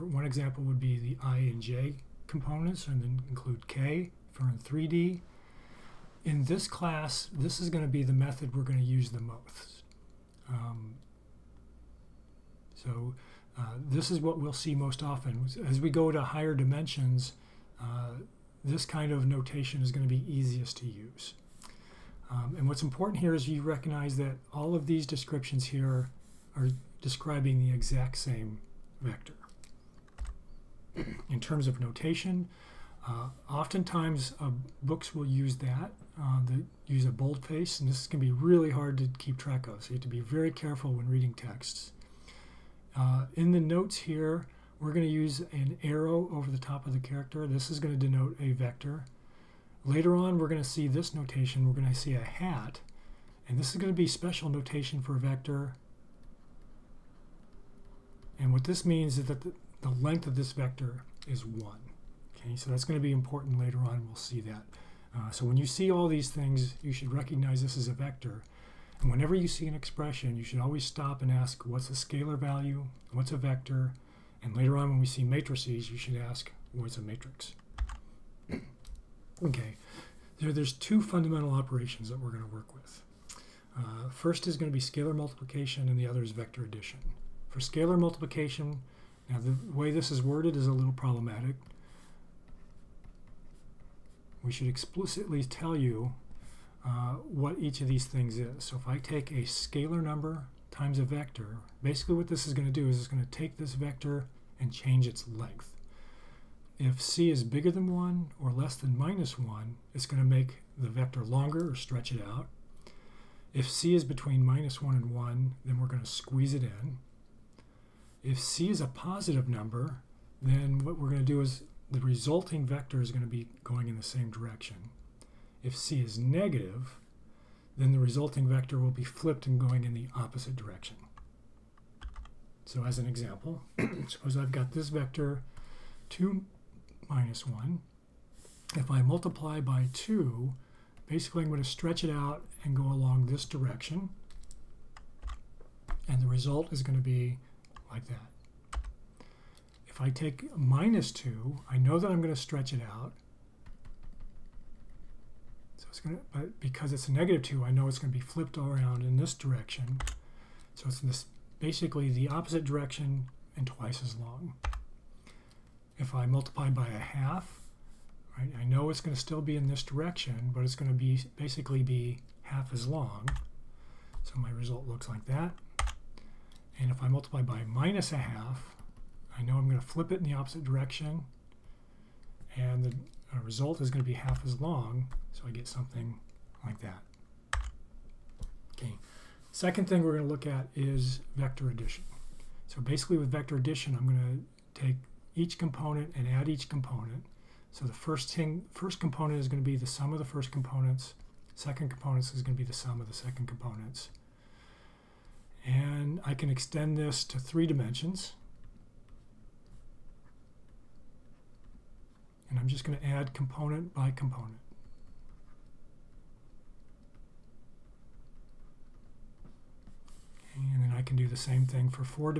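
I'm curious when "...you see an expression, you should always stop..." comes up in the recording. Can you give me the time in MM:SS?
01:09.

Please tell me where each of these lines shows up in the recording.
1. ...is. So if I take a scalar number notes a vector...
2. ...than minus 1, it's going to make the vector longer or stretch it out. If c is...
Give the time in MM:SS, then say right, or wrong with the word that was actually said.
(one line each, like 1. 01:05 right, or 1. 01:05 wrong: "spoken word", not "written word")
1. 01:38 wrong: "times", not "notes"
2. 01:48 right.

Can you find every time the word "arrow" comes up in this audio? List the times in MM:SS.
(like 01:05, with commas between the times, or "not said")
00:45.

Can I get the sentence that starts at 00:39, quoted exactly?
So you have to be very careful when reading texts.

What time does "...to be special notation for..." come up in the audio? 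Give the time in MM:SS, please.
00:53.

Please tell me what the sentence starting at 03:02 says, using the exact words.
And the our result is going to be half as long, so I get something like that.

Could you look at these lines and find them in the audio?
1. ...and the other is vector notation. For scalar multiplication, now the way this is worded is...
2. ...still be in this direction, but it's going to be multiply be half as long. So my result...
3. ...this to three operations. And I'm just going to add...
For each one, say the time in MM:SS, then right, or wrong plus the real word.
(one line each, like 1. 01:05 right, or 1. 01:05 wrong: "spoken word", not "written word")
1. 01:25 wrong: "addition", not "notation"
2. 02:49 wrong: "basically", not "multiply"
3. 03:26 wrong: "dimensions", not "operations".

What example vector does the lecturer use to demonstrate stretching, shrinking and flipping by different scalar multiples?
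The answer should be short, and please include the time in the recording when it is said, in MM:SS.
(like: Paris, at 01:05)
2, -1, at 02:16.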